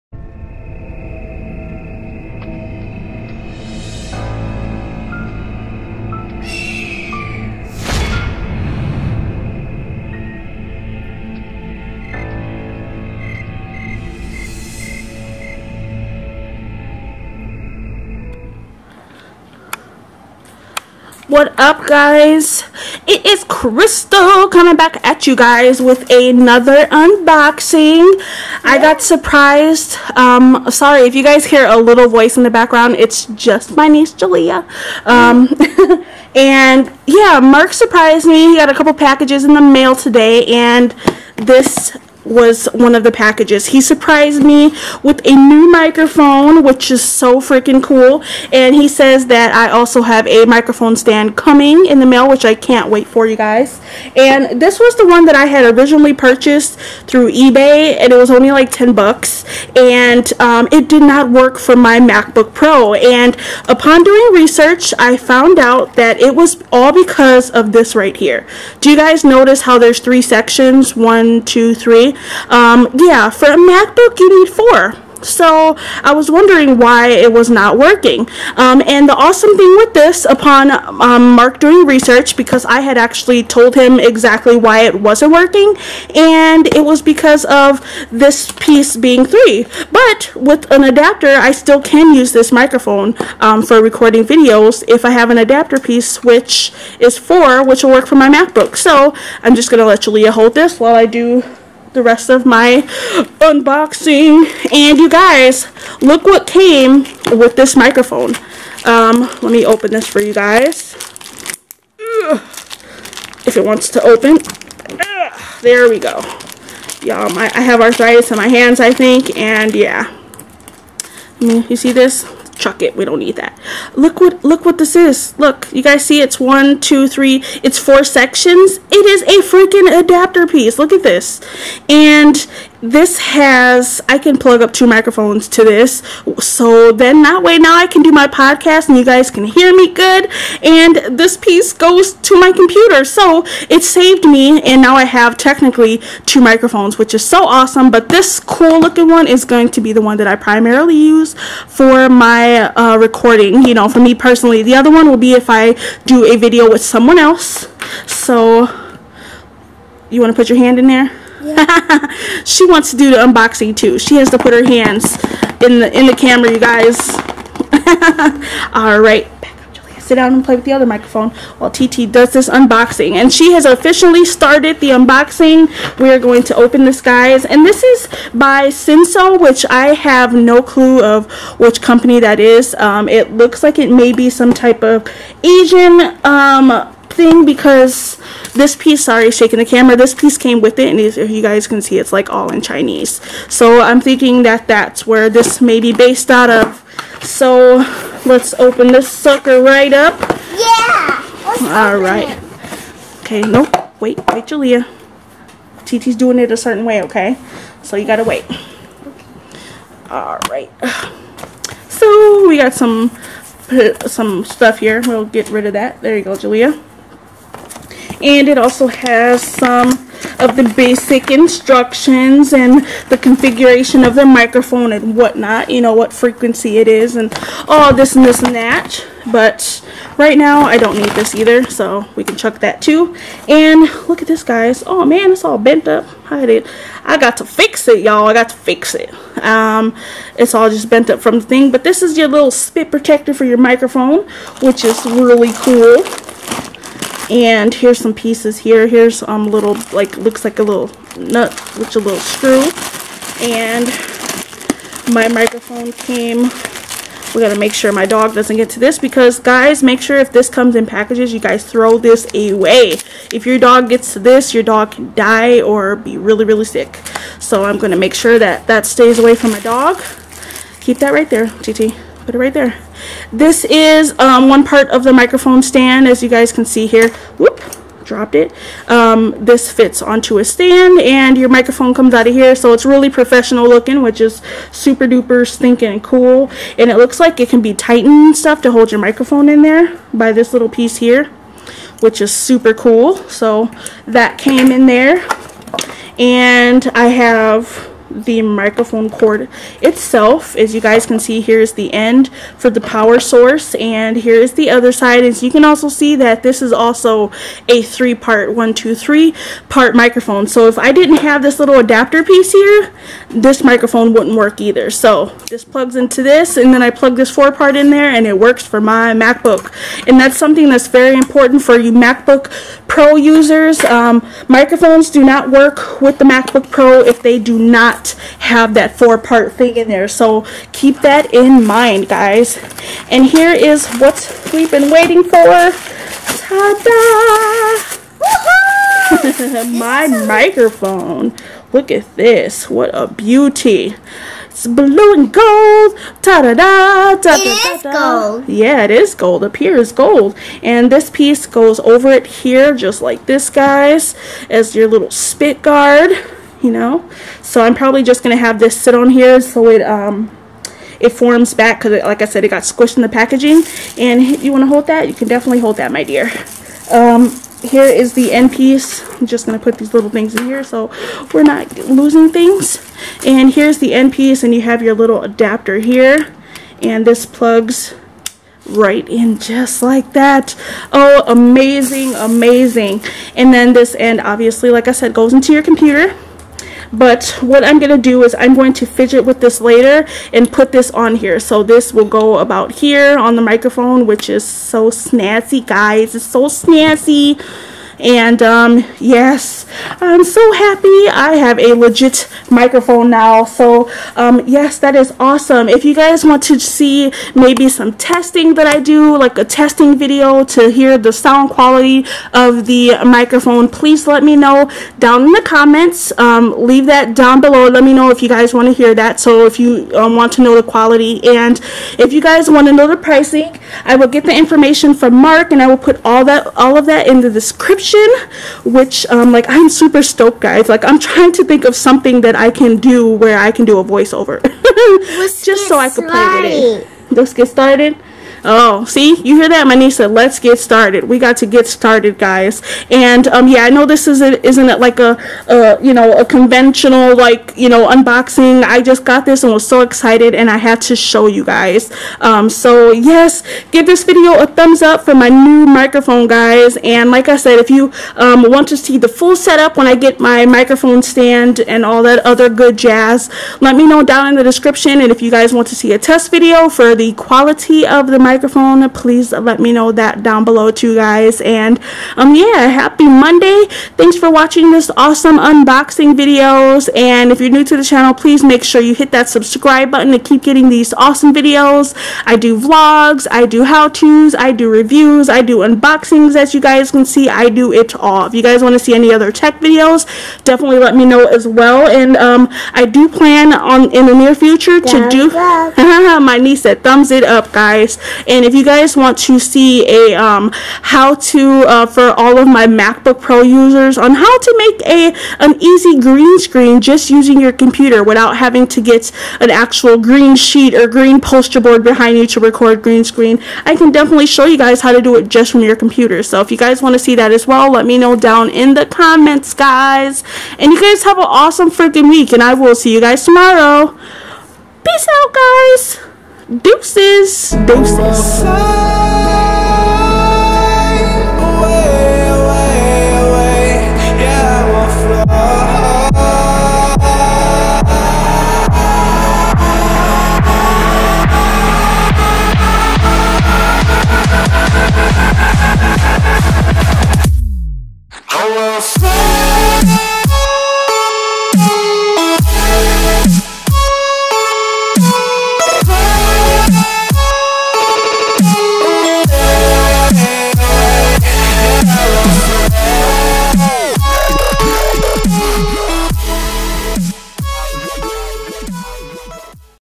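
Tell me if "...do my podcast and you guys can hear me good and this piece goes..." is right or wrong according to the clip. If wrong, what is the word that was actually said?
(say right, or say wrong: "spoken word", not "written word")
right.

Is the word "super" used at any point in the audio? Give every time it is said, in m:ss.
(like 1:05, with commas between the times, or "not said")
4:44, 4:52, 7:09.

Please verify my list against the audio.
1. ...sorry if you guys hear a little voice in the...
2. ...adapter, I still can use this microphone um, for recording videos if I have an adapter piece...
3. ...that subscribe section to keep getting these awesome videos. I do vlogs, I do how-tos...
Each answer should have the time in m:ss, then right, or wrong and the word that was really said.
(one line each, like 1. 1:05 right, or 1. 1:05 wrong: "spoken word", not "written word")
1. 0:30 right
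2. 1:30 right
3. 7:59 wrong: "button", not "section".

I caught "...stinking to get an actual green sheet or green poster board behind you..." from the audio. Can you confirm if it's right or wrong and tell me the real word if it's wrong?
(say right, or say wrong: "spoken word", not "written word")
wrong: "having", not "stinking".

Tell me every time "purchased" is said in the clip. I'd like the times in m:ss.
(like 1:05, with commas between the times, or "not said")
0:56.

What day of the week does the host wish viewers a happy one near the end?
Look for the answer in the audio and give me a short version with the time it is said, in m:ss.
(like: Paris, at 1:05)
Monday, at 7:53.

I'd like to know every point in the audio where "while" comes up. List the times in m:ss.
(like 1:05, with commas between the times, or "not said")
1:40, 2:51.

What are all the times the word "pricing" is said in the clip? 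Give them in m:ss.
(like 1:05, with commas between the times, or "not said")
7:02.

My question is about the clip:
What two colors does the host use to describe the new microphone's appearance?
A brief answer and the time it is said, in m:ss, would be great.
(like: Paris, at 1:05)
Blue and gold, at 5:44.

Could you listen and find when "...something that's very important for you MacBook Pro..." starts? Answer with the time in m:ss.
5:20.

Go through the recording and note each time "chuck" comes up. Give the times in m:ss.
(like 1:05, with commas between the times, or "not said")
2:02, 3:52.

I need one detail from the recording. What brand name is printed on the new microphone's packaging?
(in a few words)
Senso.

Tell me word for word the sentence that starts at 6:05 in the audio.
You can definitely hold that, my dear.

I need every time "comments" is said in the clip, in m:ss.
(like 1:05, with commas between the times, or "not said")
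6:55, 8:38.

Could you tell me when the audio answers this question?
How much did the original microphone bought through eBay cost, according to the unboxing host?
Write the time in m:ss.
0:58.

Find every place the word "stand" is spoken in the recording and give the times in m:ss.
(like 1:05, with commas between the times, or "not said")
0:50, 4:35, 4:40, 7:41.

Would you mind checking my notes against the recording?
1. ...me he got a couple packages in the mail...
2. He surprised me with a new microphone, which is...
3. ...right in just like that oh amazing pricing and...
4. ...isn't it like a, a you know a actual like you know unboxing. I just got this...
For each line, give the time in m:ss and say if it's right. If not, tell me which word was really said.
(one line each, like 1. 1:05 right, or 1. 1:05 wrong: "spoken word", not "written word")
1. 0:38 right
2. 0:43 right
3. 6:18 wrong: "amazing", not "pricing"
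4. 7:24 wrong: "conventional", not "actual".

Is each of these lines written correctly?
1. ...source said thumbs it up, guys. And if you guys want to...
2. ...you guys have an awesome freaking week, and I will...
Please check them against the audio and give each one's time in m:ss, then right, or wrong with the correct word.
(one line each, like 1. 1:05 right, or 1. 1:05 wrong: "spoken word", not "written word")
1. 8:16 wrong: "niece", not "source"
2. 8:40 right.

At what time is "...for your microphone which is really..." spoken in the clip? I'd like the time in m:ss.
4:03.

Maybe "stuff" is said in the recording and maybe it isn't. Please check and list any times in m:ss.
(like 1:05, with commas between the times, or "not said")
3:34, 4:48.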